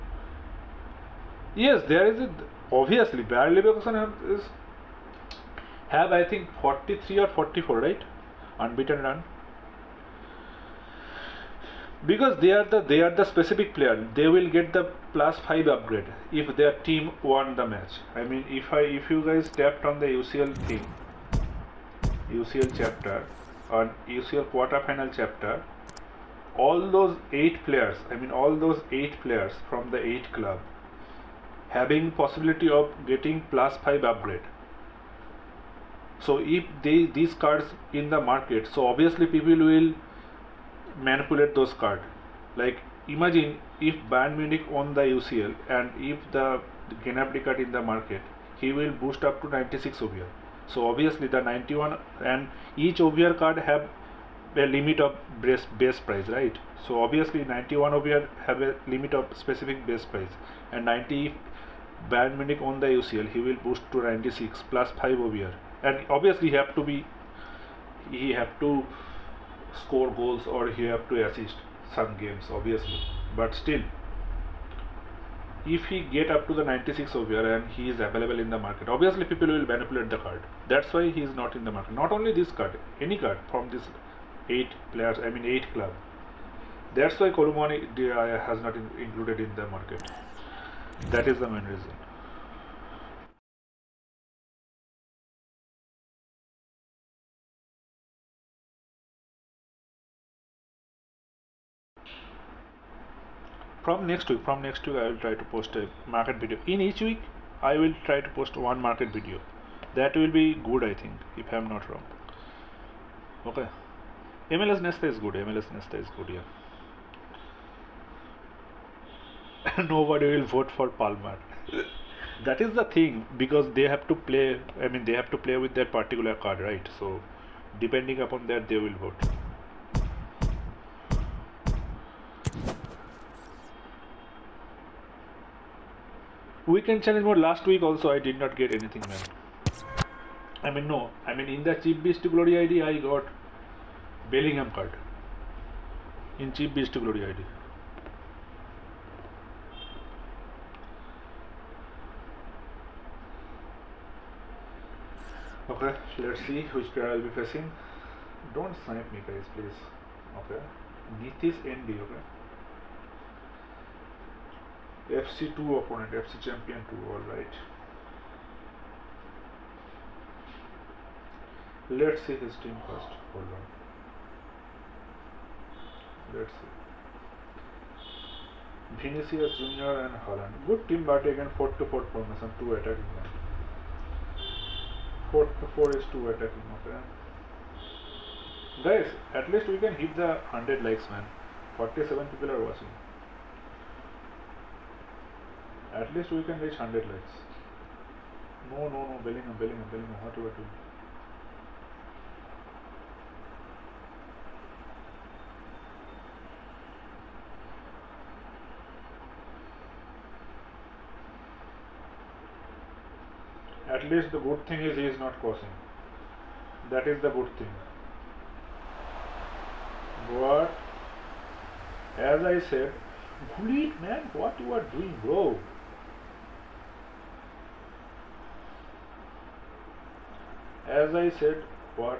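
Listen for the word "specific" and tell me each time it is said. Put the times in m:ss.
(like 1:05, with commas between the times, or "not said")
0:13, 0:59.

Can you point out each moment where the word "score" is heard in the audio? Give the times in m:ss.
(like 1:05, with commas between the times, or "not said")
1:09.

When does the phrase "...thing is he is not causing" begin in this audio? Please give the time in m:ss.
3:34.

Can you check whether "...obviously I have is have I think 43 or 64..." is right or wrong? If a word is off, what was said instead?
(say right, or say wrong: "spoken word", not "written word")
wrong: "44", not "64".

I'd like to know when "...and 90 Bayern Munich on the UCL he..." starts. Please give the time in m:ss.
1:00.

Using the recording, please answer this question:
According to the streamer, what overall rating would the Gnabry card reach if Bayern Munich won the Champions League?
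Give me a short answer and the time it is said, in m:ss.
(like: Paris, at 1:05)
96, at 0:49.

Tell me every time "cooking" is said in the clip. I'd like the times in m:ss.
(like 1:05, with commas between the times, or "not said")
not said.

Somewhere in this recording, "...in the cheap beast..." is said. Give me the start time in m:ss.
2:21.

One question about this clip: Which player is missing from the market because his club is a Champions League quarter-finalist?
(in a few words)
Kolo Muani.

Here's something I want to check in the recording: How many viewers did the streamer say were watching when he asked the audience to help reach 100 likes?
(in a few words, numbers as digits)
47.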